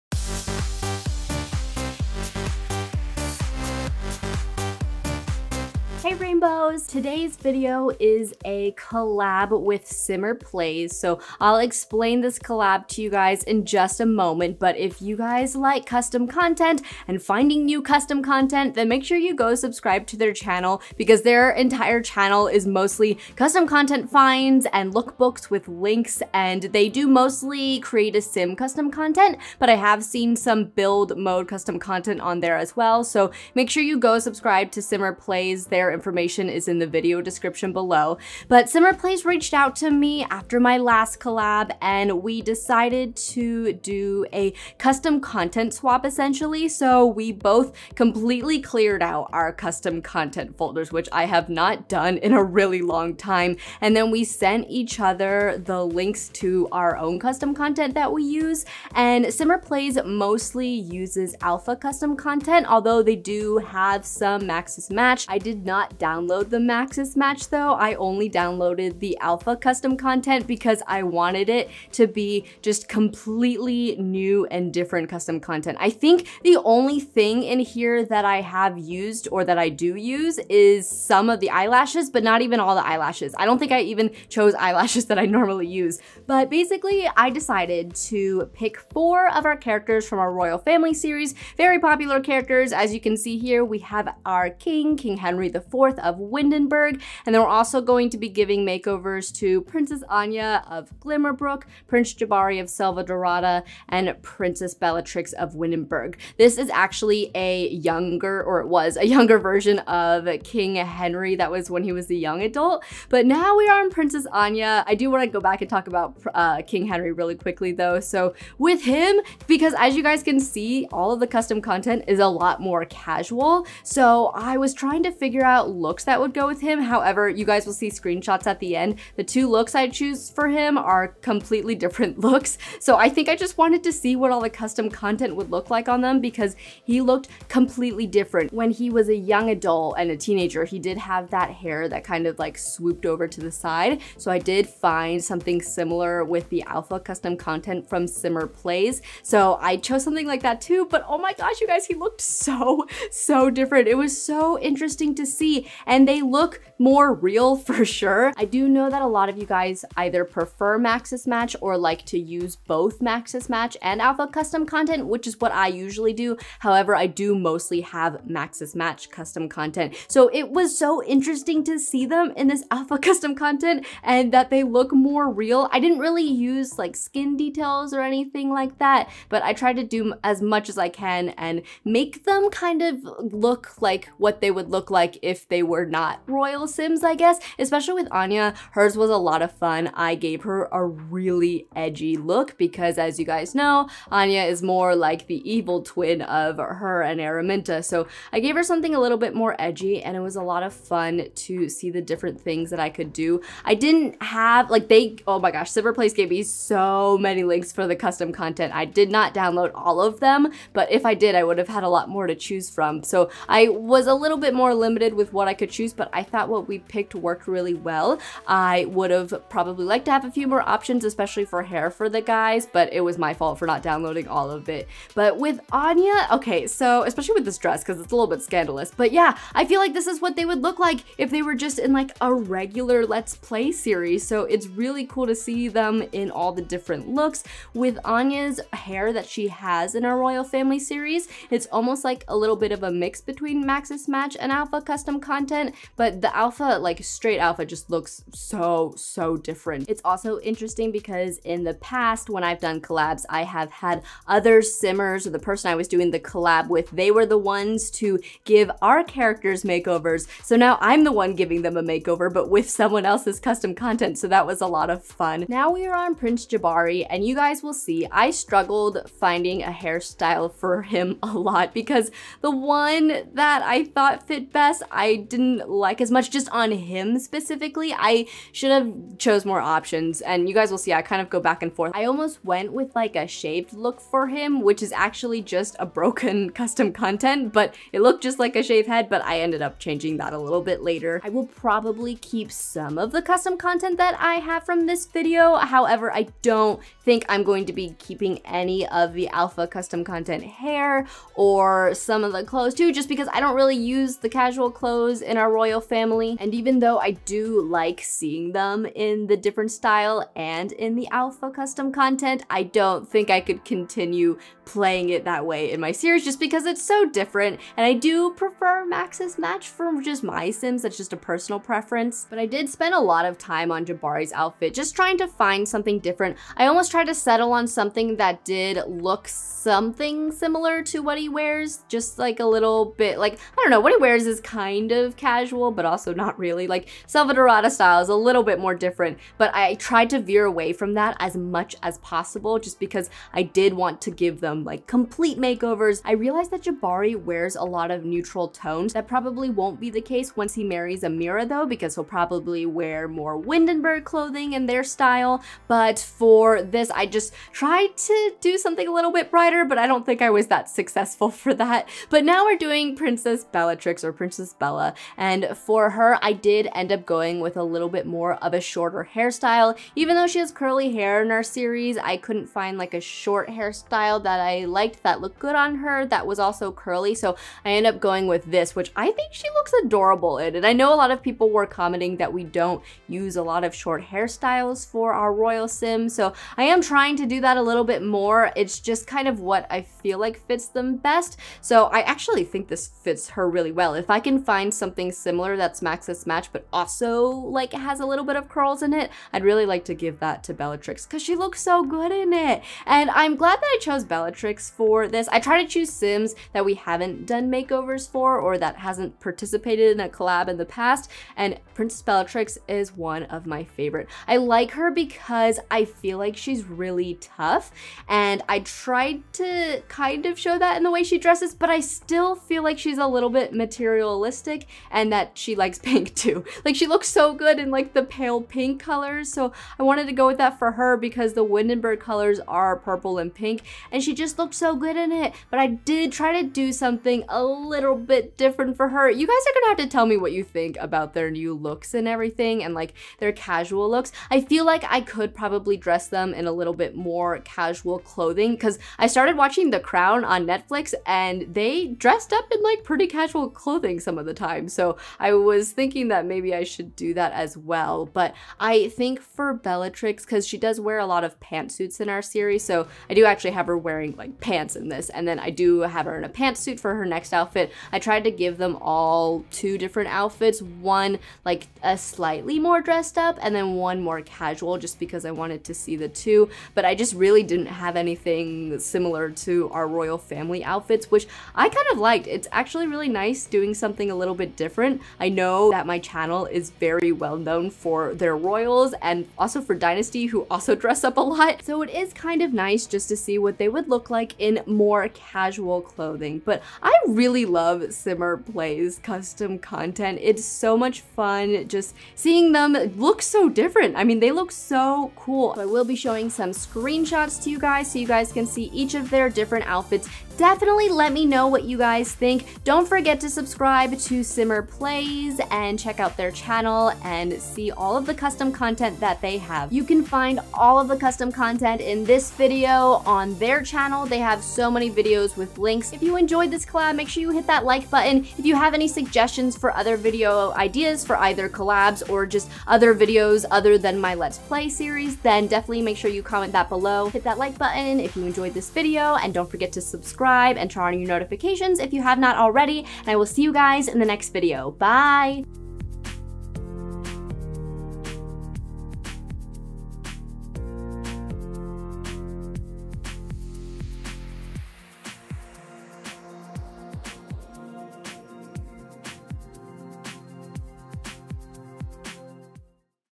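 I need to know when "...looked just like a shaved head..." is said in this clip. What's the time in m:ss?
4:48.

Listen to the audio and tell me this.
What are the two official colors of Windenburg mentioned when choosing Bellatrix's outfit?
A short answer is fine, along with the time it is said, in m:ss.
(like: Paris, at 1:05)
purple and pink, at 7:12.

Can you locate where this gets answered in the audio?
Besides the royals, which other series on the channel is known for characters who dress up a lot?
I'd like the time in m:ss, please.
8:09.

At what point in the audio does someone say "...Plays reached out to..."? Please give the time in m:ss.
0:38.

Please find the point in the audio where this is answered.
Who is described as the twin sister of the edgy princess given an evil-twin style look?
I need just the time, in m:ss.
3:17.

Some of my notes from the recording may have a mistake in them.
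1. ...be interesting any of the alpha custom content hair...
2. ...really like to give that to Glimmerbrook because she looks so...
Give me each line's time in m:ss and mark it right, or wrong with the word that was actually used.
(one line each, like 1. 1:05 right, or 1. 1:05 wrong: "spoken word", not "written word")
1. 4:57 wrong: "keeping", not "interesting"
2. 6:39 wrong: "Bellatrix", not "Glimmerbrook".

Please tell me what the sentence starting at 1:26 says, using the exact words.
But basically, I decided to pick four of our characters from our royal family series, very popular characters.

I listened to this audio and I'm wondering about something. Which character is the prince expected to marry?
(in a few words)
Amira.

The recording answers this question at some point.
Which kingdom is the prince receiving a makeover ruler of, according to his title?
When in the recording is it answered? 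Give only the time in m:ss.
1:41.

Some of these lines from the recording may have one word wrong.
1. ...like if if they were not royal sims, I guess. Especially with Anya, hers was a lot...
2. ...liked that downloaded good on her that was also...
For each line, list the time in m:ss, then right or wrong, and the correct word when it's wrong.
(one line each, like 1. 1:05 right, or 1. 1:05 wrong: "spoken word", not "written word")
1. 3:04 right
2. 6:14 wrong: "looked", not "downloaded".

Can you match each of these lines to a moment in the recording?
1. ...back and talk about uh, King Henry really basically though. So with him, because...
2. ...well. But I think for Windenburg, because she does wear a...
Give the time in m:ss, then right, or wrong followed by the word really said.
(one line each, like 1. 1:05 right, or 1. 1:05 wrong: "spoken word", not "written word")
1. 1:55 wrong: "quickly", not "basically"
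2. 7:37 wrong: "Bellatrix", not "Windenburg".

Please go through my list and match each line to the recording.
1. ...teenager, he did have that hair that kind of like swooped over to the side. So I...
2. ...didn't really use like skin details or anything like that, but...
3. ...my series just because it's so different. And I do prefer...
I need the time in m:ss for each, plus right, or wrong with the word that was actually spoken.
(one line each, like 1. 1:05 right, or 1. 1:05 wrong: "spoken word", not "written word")
1. 2:20 right
2. 2:55 right
3. 5:15 right.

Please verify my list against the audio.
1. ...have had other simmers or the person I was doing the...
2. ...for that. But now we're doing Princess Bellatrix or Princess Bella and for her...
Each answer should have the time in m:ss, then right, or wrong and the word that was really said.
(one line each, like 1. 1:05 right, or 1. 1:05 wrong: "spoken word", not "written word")
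1. 4:13 right
2. 6:01 right.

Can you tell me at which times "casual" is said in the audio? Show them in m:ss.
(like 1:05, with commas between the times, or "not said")
2:02, 5:04, 5:35, 7:23, 7:27, 7:33, 7:54, 8:15.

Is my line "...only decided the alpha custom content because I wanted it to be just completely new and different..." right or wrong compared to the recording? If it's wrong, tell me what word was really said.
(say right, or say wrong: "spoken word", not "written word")
wrong: "downloaded", not "decided".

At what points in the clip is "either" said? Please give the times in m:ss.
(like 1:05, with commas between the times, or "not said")
2:39, 8:51.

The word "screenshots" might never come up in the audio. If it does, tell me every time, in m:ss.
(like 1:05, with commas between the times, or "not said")
2:07, 8:26.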